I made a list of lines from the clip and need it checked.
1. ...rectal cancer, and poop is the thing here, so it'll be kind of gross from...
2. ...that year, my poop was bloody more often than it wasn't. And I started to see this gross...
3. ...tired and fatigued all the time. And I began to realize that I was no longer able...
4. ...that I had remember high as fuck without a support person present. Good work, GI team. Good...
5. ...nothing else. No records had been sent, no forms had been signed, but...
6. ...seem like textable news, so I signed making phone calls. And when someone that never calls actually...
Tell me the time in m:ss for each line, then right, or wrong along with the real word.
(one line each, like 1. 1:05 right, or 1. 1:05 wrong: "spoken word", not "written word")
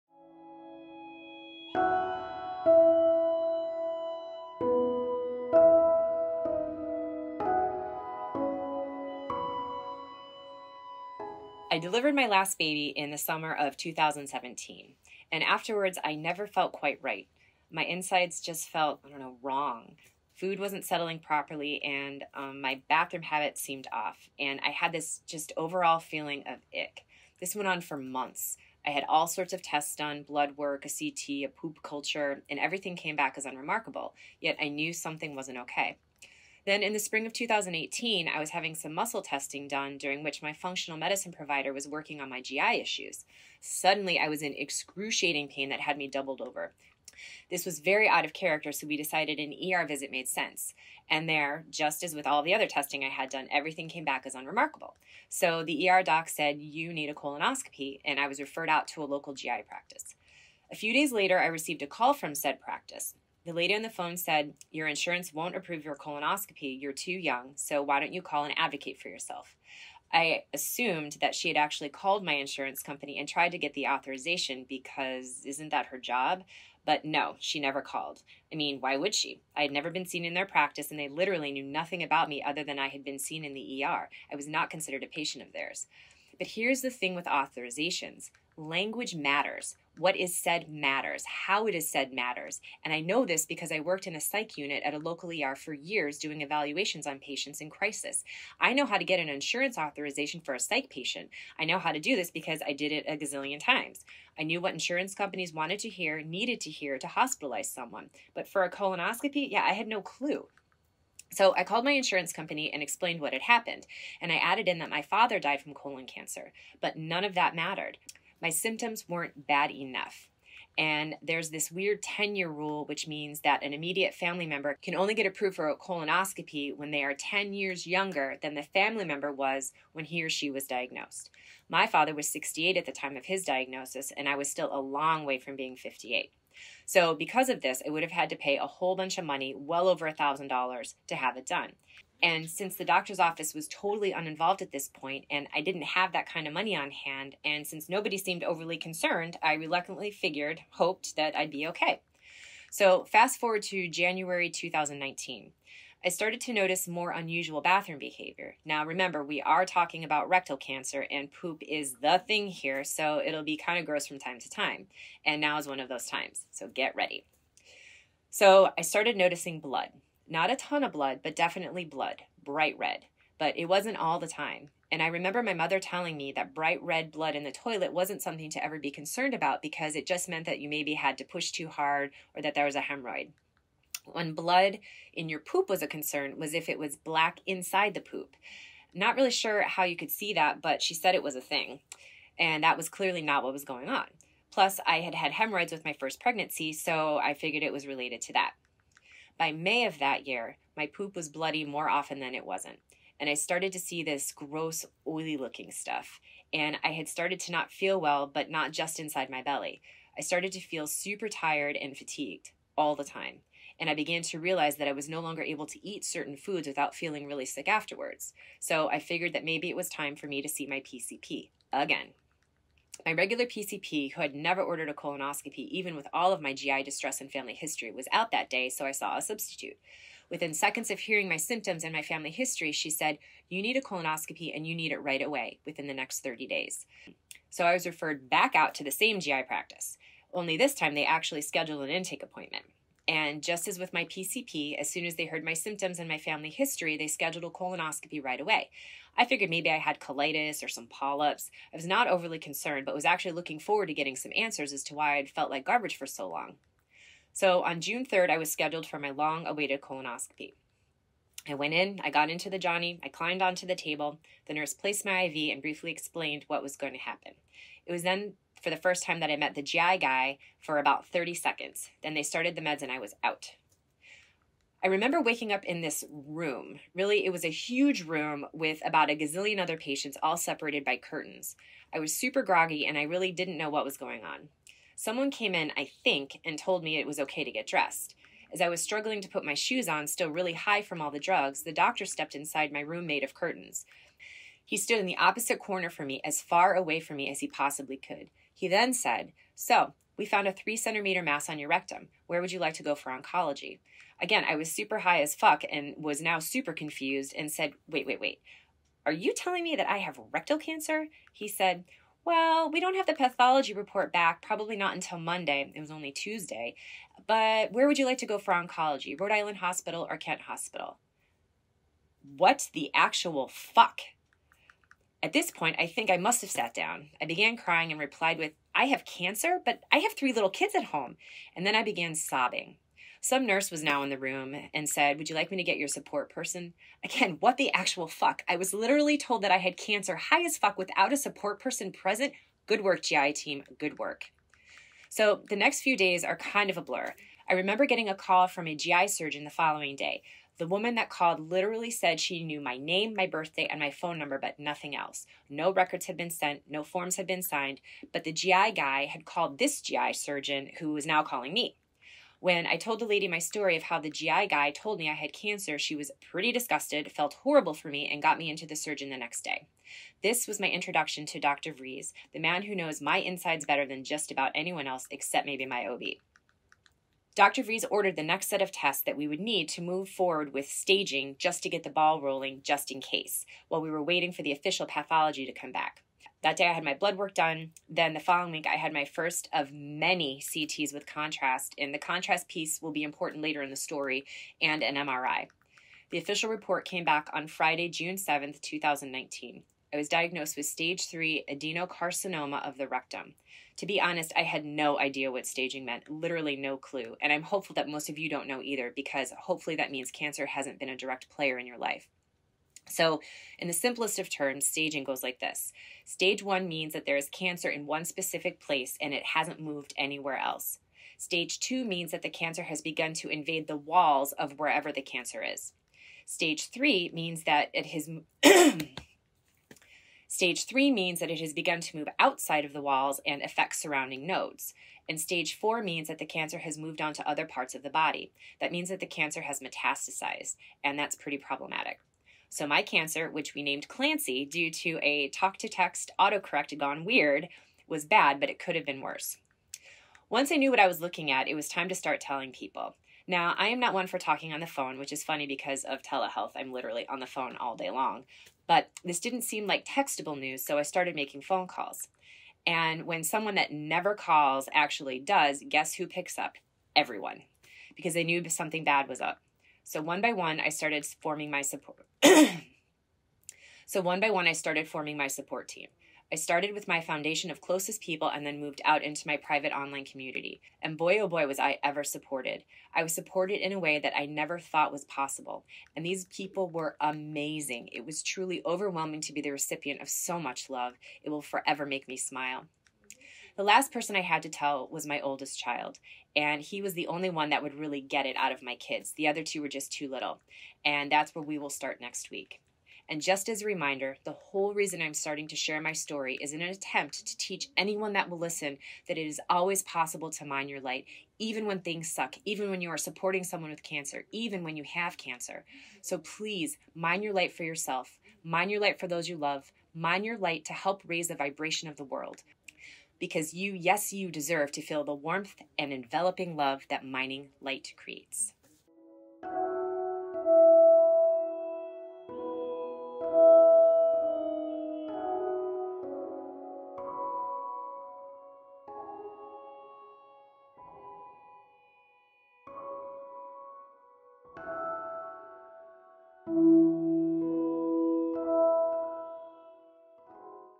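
1. 2:40 right
2. 3:19 right
3. 3:31 right
4. 5:39 wrong: "cancer", not "remember"
5. 5:54 right
6. 7:39 wrong: "started", not "signed".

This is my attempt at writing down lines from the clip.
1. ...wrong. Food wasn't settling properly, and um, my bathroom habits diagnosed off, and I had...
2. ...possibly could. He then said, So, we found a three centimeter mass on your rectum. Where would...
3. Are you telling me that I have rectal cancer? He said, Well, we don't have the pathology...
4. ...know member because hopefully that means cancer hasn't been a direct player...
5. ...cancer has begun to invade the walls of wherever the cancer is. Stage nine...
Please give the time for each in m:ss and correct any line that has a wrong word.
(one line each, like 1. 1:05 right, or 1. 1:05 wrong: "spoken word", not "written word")
1. 0:19 wrong: "seemed", not "diagnosed"
2. 4:57 right
3. 5:09 right
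4. 6:48 wrong: "either", not "member"
5. 7:02 wrong: "three", not "nine".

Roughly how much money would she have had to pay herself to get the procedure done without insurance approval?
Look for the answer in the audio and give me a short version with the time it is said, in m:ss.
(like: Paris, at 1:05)
over $1,000, at 2:19.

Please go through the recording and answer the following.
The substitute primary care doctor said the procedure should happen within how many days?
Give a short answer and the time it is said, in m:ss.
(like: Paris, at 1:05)
30, at 3:56.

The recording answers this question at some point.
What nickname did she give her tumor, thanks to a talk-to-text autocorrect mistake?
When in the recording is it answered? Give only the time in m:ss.
7:23.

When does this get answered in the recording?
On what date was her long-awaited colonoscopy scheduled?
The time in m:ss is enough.
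4:17.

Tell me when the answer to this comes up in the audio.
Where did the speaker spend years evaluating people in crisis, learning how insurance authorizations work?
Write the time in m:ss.
1:34.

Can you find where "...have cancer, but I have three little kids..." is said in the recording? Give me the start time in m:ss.
5:28.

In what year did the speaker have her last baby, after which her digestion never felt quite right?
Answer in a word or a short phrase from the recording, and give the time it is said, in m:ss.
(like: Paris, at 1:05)
2017, at 0:13.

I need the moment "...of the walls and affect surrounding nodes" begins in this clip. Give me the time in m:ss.
7:12.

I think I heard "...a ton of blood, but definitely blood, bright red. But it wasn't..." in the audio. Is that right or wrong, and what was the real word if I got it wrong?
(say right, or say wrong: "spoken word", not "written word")
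right.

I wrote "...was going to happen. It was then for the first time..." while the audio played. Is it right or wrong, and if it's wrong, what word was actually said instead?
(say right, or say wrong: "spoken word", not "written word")
right.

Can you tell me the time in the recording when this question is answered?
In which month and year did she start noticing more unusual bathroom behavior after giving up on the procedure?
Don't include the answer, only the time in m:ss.
2:33.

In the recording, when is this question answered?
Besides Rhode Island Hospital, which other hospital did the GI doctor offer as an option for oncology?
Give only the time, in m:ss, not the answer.
5:20.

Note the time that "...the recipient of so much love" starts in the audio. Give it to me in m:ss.
8:09.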